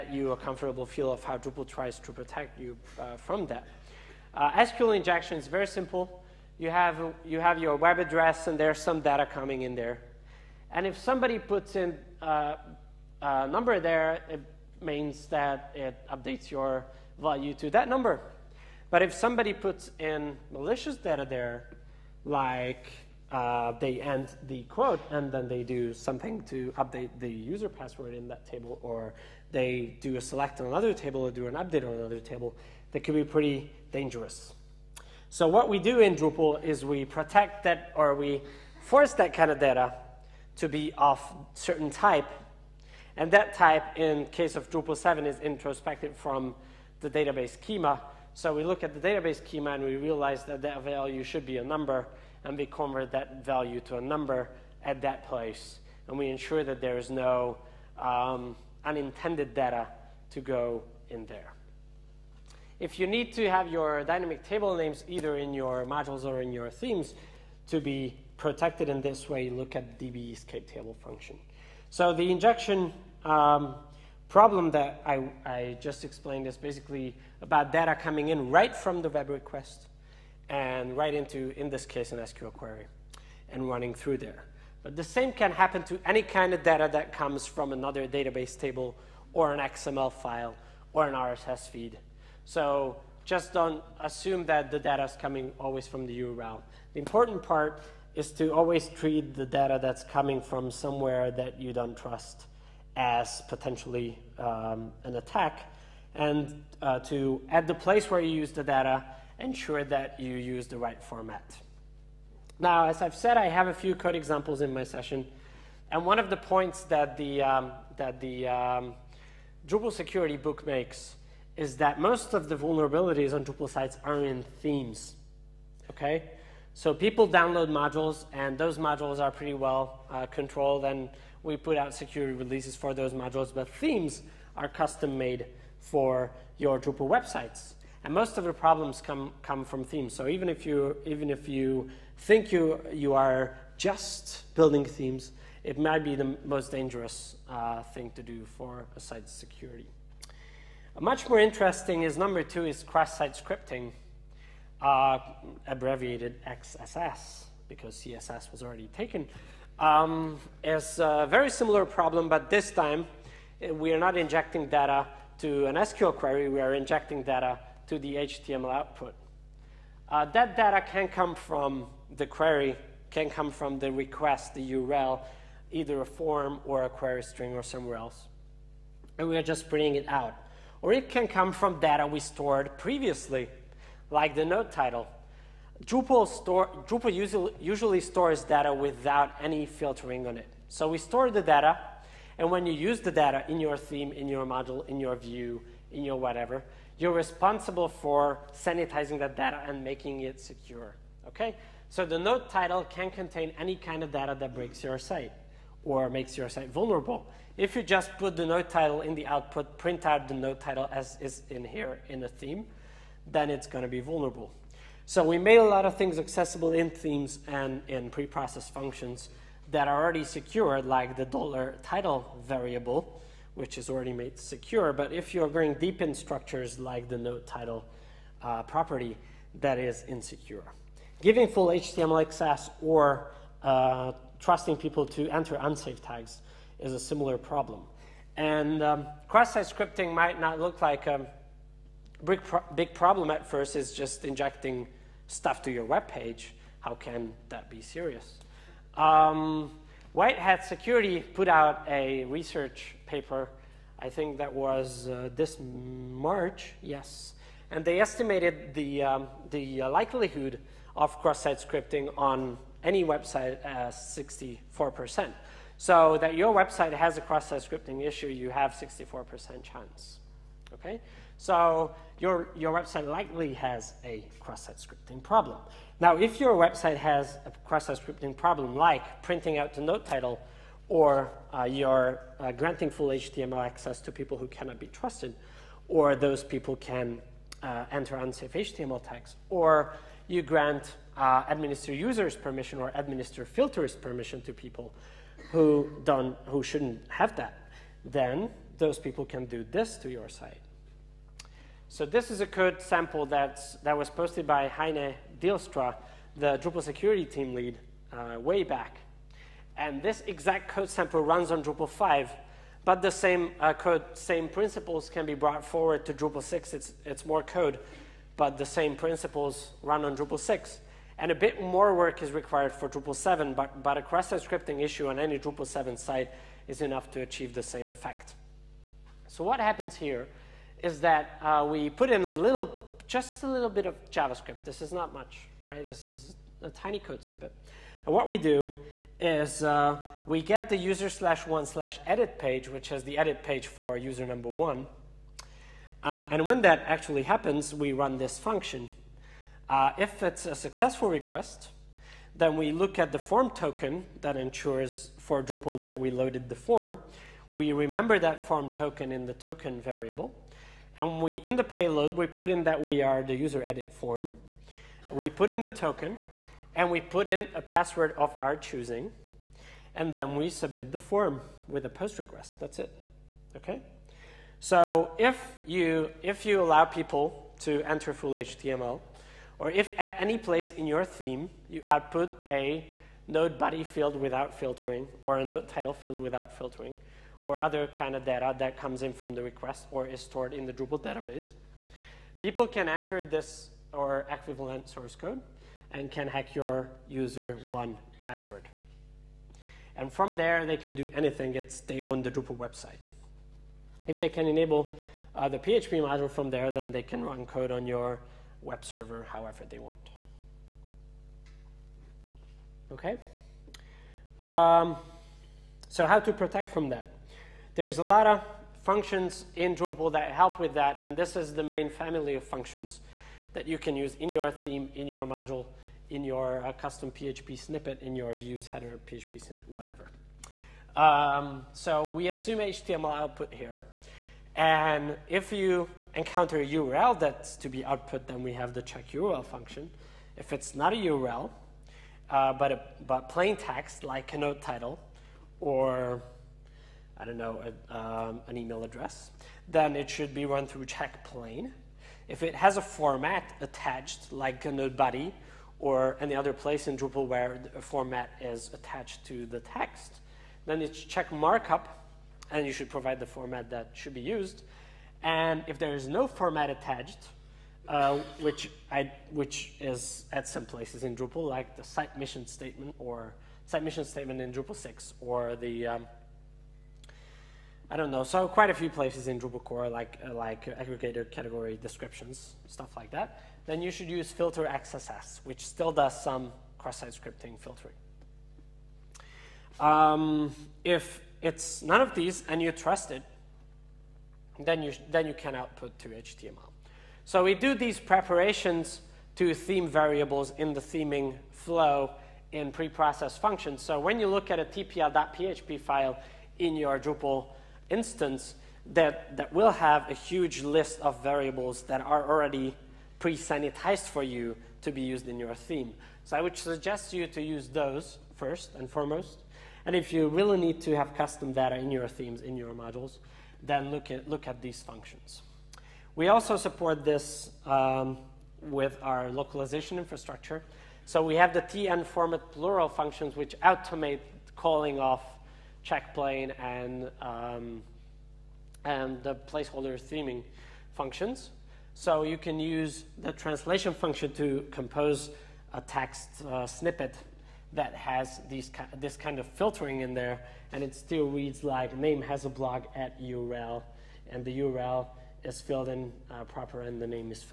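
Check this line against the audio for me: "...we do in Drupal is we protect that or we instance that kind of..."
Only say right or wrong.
wrong.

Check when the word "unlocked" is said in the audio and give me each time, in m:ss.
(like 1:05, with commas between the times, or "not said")
not said.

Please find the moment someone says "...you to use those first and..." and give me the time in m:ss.
8:37.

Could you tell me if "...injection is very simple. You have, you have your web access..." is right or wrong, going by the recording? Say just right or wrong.
wrong.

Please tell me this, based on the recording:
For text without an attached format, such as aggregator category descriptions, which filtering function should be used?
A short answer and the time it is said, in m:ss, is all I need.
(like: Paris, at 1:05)
filter XSS, at 8:04.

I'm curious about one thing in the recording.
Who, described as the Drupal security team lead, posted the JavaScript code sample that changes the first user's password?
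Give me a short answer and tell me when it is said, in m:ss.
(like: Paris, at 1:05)
Heine Deelstra, at 5:04.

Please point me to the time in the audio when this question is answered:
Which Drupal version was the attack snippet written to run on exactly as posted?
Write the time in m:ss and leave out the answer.
5:11.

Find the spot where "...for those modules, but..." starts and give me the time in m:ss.
2:12.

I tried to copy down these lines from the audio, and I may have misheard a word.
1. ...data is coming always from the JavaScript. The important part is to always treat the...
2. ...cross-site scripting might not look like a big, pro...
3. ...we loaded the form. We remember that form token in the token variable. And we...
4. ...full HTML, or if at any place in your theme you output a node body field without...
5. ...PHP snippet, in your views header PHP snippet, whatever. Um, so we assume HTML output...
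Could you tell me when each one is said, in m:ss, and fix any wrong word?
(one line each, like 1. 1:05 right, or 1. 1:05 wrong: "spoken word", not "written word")
1. 1:34 wrong: "URL", not "JavaScript"
2. 3:59 right
3. 5:55 right
4. 6:18 right
5. 7:07 right.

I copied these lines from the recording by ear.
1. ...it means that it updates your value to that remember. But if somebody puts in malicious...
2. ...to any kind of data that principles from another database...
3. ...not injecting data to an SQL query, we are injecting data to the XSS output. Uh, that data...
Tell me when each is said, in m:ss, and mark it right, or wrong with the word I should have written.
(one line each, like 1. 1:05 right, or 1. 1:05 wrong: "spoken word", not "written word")
1. 0:14 wrong: "number", not "remember"
2. 1:25 wrong: "comes", not "principles"
3. 2:43 wrong: "HTML", not "XSS".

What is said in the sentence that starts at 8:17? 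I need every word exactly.
So we do these preparations to theme variables in the theming flow in preprocess functions.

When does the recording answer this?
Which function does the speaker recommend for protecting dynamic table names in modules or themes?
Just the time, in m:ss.
1:09.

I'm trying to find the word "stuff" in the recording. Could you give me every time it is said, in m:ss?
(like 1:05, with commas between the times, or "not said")
4:05, 8:02.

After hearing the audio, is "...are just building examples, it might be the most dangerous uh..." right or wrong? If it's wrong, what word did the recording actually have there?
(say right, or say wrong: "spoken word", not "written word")
wrong: "themes", not "examples".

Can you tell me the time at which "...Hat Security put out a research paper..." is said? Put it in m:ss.
4:10.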